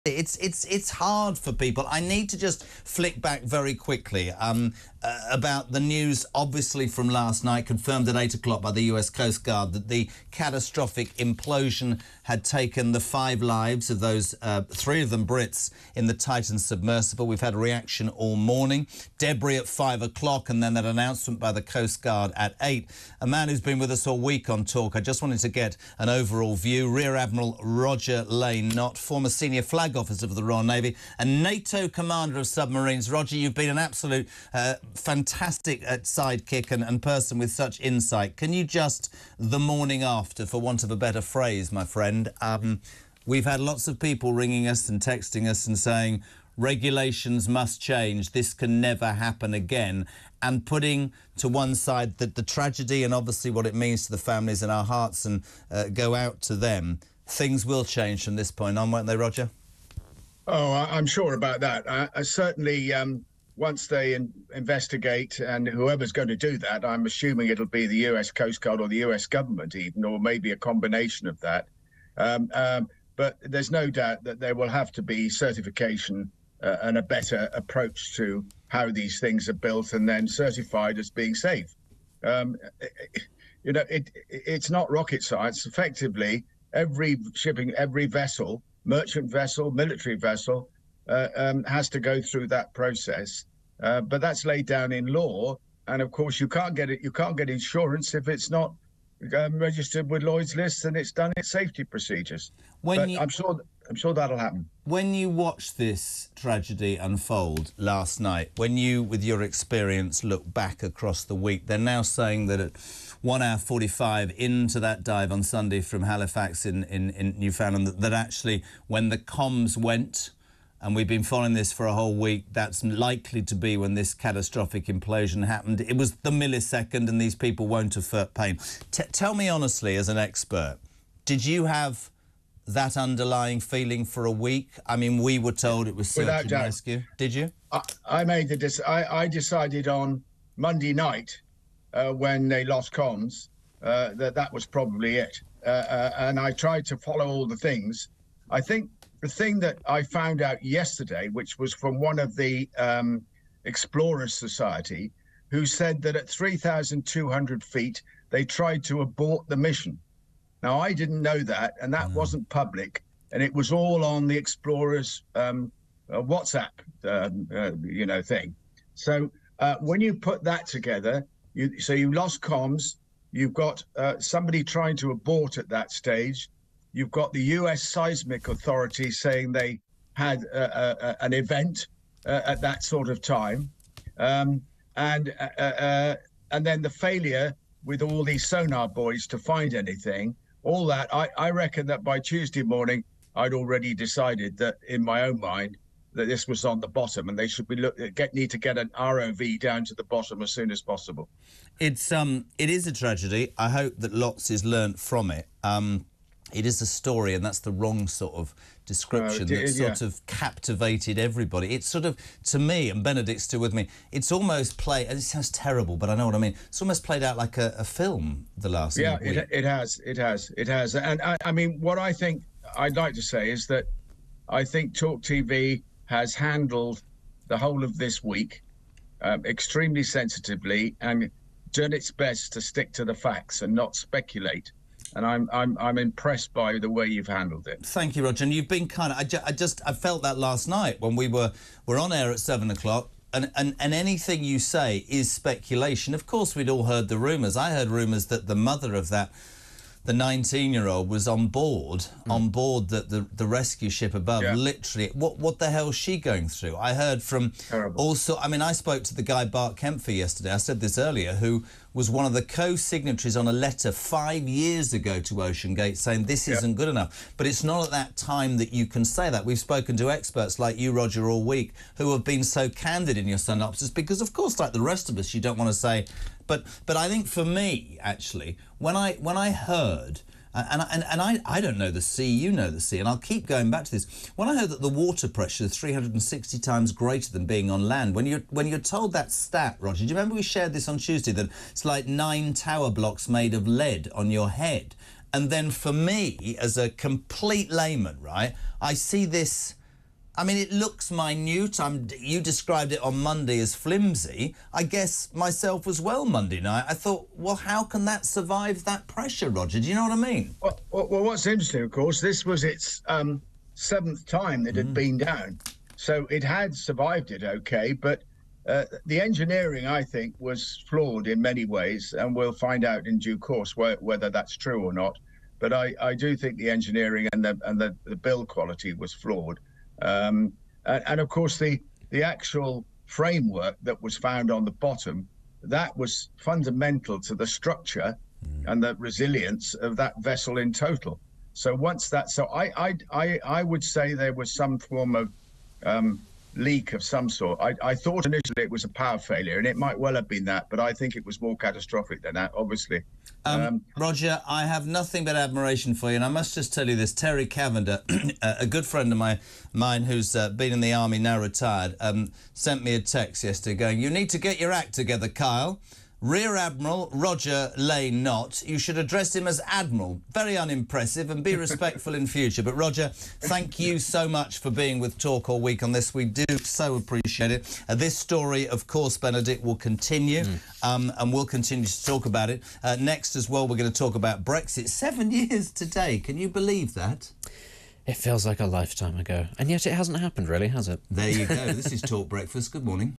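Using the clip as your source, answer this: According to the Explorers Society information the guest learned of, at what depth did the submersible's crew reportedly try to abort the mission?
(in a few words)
3,200 feet.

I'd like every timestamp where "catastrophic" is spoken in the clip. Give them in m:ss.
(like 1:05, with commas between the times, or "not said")
0:10, 2:04, 5:51.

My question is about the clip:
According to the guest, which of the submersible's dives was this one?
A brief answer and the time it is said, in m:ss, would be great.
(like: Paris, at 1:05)
seventh, at 5:13.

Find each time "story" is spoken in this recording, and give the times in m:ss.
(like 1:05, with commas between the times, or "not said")
3:26, 6:18.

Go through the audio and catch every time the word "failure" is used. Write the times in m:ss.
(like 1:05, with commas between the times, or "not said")
3:06, 5:49.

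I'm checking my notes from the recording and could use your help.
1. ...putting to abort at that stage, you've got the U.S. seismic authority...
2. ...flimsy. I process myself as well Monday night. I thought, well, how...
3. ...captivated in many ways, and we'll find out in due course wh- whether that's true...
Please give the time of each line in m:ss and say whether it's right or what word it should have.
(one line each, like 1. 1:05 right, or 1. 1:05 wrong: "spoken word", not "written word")
1. 2:54 wrong: "trying", not "putting"
2. 5:03 wrong: "guess", not "process"
3. 5:20 wrong: "flawed", not "captivated".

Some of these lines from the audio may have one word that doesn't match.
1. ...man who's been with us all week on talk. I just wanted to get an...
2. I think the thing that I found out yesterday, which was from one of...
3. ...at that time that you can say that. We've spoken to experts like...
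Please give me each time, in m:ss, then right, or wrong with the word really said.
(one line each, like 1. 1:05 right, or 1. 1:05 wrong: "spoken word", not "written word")
1. 0:23 right
2. 2:28 right
3. 4:27 right.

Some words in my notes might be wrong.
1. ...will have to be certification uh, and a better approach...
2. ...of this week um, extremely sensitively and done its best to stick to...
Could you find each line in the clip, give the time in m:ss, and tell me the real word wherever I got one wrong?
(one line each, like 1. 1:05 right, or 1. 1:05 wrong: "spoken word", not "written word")
1. 1:14 right
2. 3:47 right.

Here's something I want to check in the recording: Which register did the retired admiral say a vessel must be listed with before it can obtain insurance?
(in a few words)
Lloyd's list.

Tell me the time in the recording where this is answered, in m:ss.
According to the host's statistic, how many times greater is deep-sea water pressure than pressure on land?
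4:45.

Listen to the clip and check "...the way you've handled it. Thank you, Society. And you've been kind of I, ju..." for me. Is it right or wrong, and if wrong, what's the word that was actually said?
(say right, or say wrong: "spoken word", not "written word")
wrong: "Roger", not "Society".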